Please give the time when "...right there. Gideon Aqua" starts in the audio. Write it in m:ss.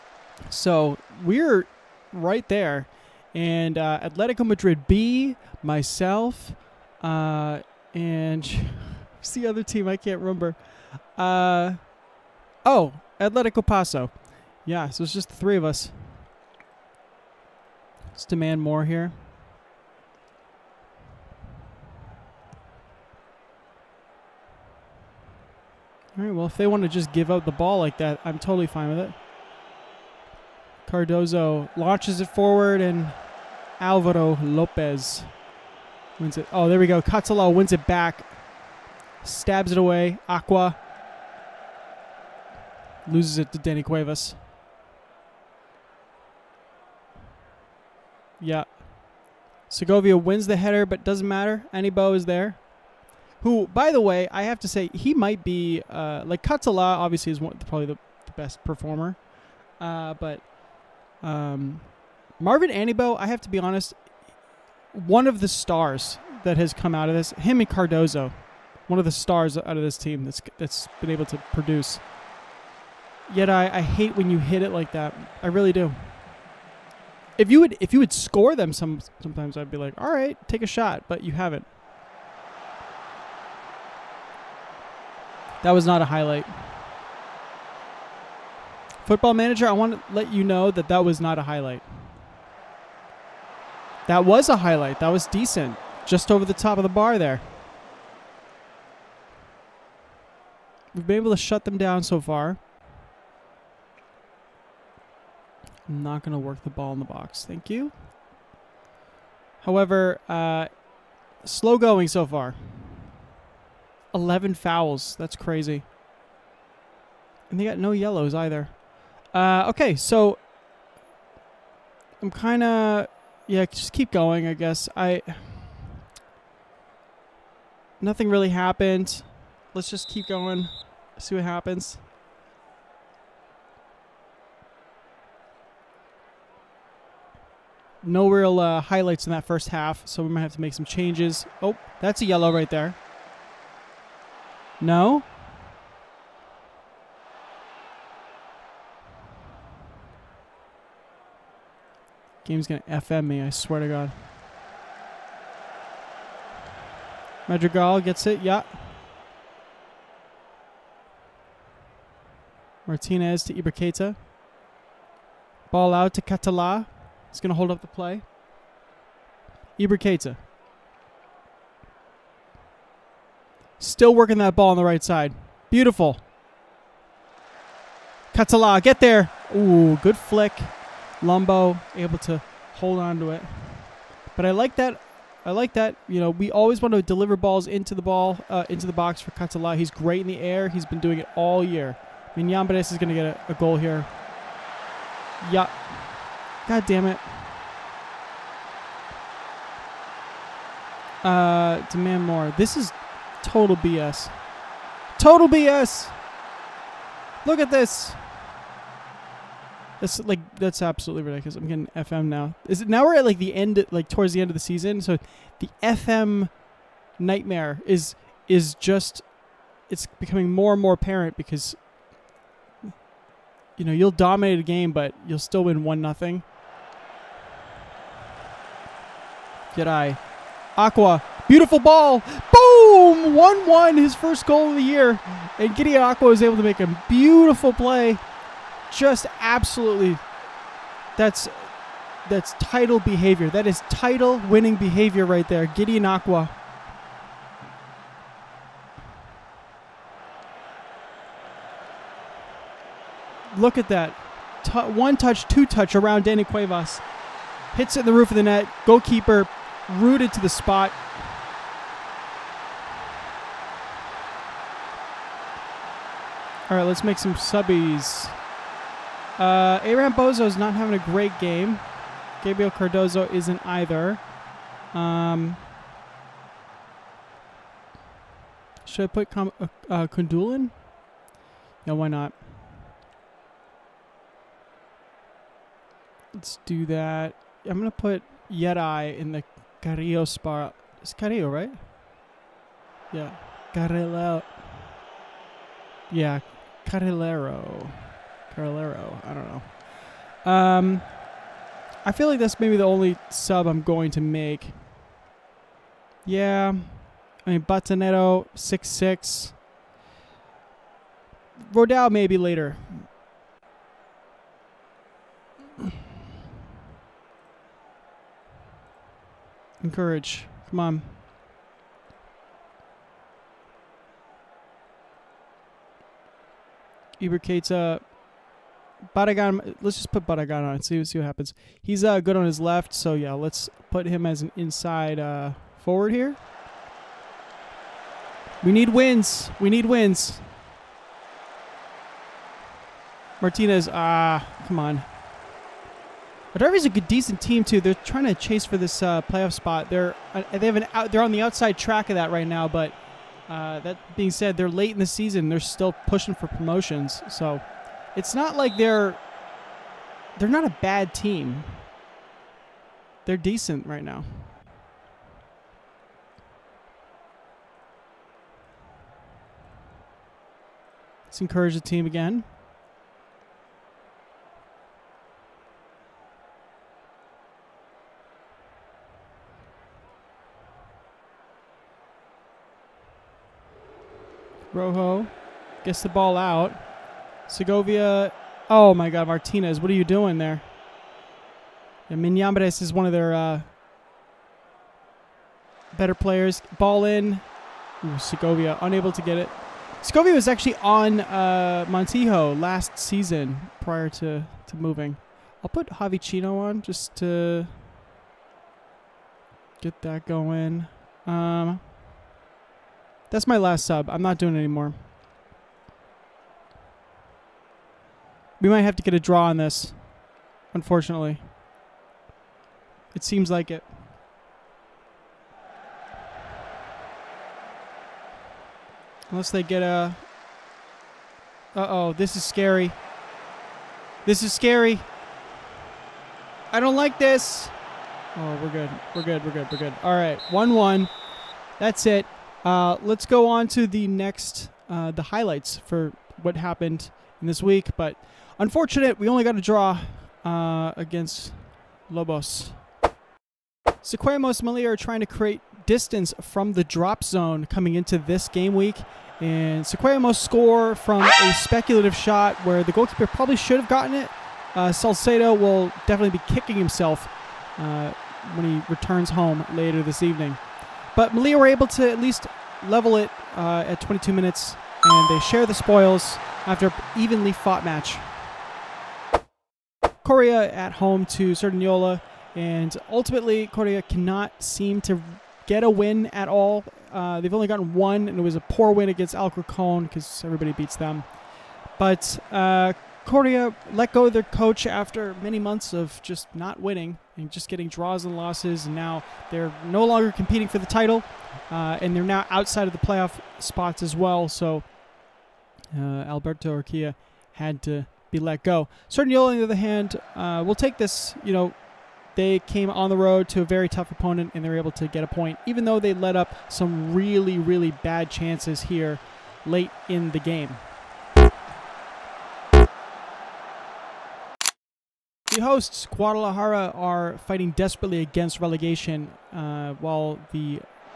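4:05.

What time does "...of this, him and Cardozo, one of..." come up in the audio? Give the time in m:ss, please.
1:07.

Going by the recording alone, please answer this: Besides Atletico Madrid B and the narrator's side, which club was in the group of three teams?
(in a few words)
Atletico Paso.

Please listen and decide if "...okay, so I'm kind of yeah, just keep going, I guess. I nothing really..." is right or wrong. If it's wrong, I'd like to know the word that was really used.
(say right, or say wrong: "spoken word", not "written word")
right.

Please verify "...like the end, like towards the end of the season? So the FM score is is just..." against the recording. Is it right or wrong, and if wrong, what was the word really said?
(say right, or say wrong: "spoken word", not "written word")
wrong: "nightmare", not "score".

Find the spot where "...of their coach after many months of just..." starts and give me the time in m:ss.
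8:14.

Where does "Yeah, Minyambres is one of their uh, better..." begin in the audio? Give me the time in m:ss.
6:32.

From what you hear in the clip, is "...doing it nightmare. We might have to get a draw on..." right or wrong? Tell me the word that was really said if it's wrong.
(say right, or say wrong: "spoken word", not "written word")
wrong: "anymore", not "nightmare".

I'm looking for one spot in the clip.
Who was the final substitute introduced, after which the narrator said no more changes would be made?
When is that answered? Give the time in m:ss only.
6:45.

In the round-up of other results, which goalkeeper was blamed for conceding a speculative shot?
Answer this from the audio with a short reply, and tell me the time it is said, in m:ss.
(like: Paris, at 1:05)
Salcedo, at 7:44.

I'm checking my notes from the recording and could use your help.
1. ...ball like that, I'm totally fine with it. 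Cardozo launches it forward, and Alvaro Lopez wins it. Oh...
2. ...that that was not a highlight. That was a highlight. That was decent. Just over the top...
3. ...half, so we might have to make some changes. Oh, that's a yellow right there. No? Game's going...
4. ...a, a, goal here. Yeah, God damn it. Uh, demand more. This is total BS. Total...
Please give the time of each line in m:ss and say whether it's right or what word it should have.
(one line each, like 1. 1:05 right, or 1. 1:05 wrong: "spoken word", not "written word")
1. 0:27 right
2. 1:30 right
3. 2:19 right
4. 3:13 right.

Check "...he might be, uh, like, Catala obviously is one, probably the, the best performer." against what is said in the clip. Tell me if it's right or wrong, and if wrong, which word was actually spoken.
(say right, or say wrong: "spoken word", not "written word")
right.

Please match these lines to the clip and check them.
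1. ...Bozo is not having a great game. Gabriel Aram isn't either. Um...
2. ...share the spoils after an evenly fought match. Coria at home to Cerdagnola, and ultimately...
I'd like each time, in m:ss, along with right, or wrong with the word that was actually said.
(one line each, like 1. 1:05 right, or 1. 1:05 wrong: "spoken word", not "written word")
1. 4:30 wrong: "Cardozo", not "Aram"
2. 7:55 right.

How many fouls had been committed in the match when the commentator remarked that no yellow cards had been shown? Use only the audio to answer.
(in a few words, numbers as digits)
11.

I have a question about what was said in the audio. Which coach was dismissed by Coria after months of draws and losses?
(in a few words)
Alberto Urquia.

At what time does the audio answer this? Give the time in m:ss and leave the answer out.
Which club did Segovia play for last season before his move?
6:41.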